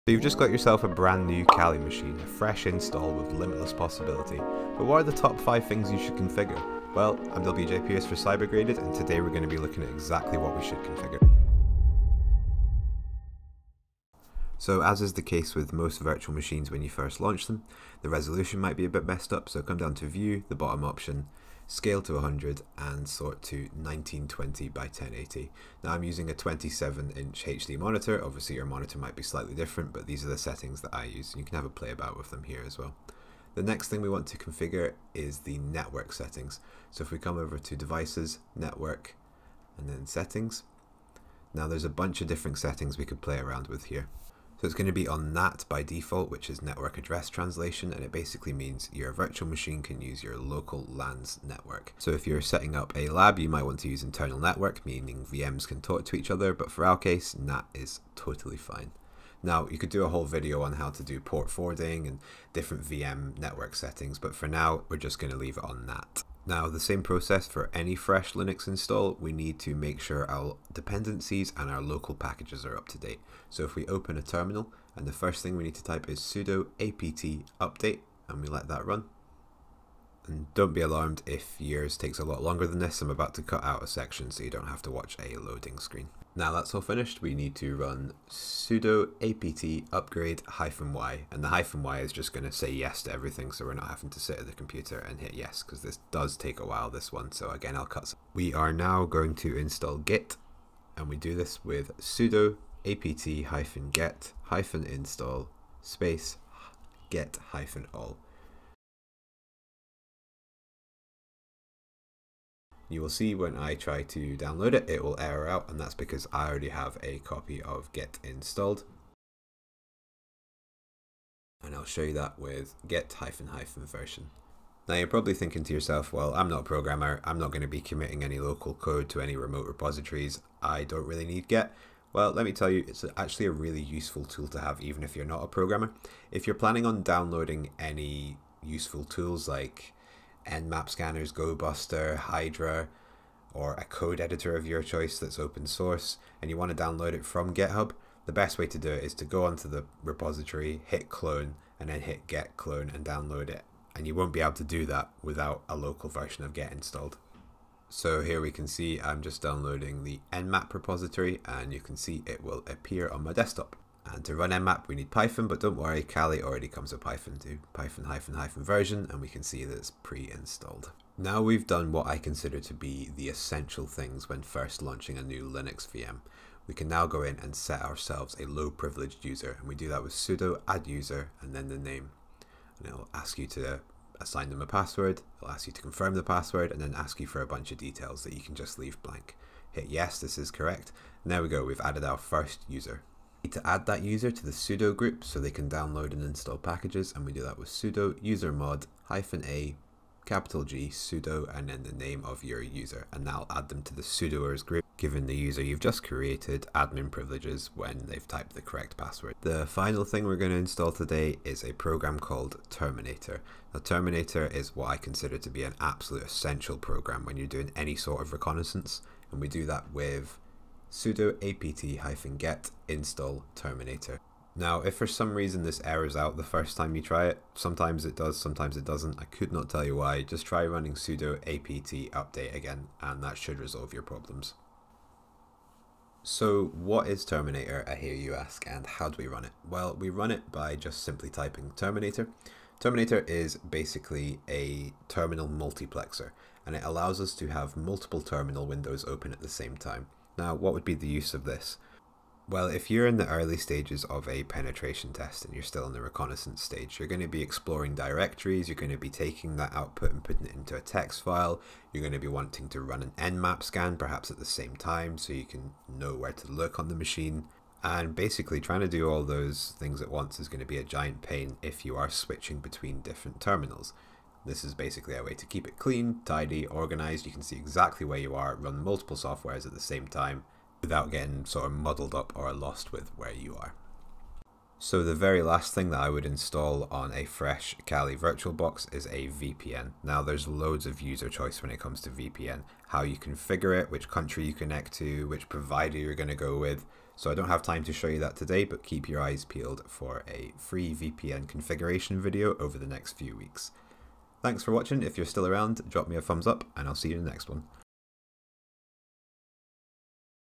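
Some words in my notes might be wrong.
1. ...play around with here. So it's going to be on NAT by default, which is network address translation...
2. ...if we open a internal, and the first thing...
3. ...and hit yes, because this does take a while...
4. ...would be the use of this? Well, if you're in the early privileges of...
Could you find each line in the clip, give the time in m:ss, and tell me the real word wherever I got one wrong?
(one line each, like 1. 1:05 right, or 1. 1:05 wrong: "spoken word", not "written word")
1. 0:43 right
2. 1:13 wrong: "terminal", not "internal"
3. 1:34 right
4. 4:10 wrong: "stages", not "privileges".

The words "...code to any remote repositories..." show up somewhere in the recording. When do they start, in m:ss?
2:08.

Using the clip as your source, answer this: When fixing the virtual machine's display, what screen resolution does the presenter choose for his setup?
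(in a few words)
1920 by 1080.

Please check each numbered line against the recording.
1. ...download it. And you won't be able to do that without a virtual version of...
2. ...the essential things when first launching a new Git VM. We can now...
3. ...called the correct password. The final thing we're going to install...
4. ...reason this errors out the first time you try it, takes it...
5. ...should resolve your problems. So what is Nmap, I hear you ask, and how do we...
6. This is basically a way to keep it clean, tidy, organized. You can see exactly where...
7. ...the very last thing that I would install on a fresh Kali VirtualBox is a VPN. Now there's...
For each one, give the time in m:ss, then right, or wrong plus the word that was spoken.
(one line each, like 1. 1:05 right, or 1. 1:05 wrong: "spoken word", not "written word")
1. 2:33 wrong: "local", not "virtual"
2. 2:53 wrong: "Linux", not "Git"
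3. 3:28 wrong: "typed", not "called"
4. 3:45 wrong: "sometimes", not "takes"
5. 3:53 wrong: "Terminator", not "Nmap"
6. 4:34 right
7. 4:45 right.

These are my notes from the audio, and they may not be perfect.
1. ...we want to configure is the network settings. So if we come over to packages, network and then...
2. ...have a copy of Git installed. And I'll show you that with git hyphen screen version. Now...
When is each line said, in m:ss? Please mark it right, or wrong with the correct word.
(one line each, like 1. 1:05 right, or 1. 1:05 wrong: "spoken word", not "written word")
1. 0:34 wrong: "devices", not "packages"
2. 1:56 wrong: "hyphen", not "screen".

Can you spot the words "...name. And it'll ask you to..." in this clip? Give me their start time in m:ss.
3:01.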